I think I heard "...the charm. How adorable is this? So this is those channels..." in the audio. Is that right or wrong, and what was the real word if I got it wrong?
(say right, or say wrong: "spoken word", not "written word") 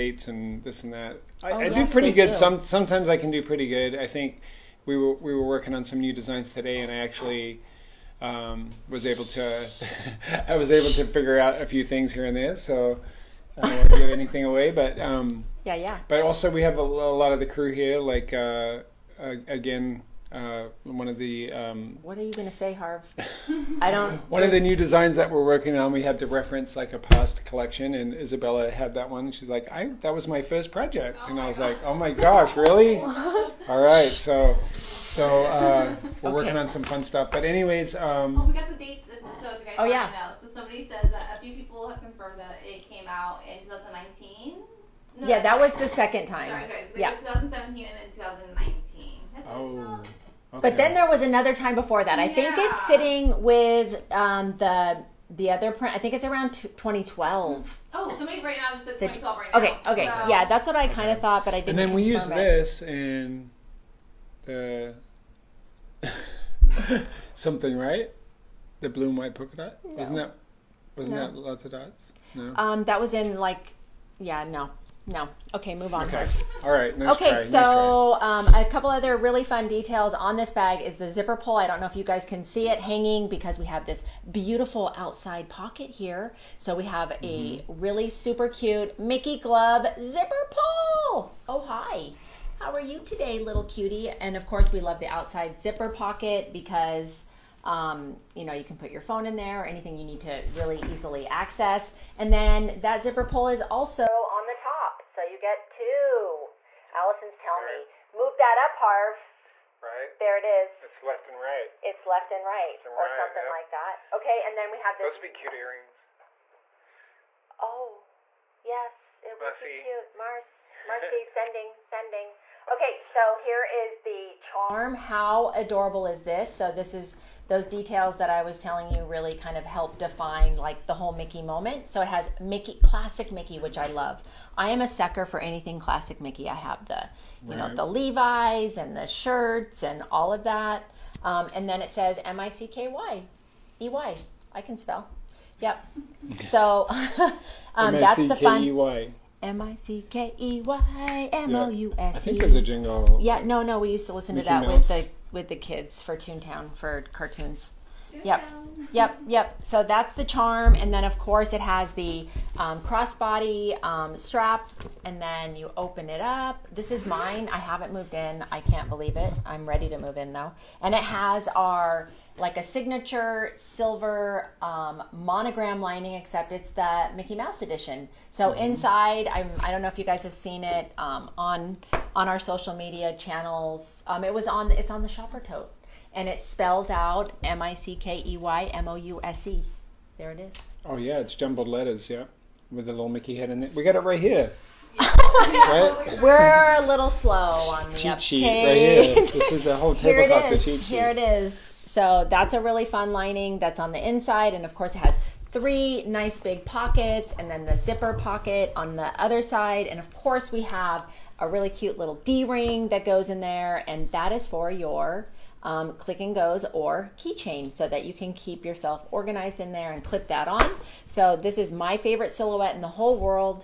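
wrong: "details", not "channels".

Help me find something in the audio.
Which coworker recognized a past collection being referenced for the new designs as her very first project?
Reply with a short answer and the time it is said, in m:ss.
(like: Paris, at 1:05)
Isabella, at 0:28.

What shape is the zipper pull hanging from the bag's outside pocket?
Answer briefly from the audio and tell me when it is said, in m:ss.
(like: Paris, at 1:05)
Mickey glove, at 1:28.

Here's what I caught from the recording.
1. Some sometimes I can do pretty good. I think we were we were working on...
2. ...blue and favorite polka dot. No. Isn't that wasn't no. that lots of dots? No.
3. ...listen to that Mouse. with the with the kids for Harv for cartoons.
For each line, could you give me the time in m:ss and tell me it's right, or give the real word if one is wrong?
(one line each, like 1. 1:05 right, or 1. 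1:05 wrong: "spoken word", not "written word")
1. 0:02 right
2. 1:08 wrong: "white", not "favorite"
3. 2:34 wrong: "Toontown", not "Harv".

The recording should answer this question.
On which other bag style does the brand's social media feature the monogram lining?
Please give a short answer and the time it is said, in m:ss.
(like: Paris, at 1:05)
shopper tote, at 3:05.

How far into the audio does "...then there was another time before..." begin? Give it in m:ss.
0:50.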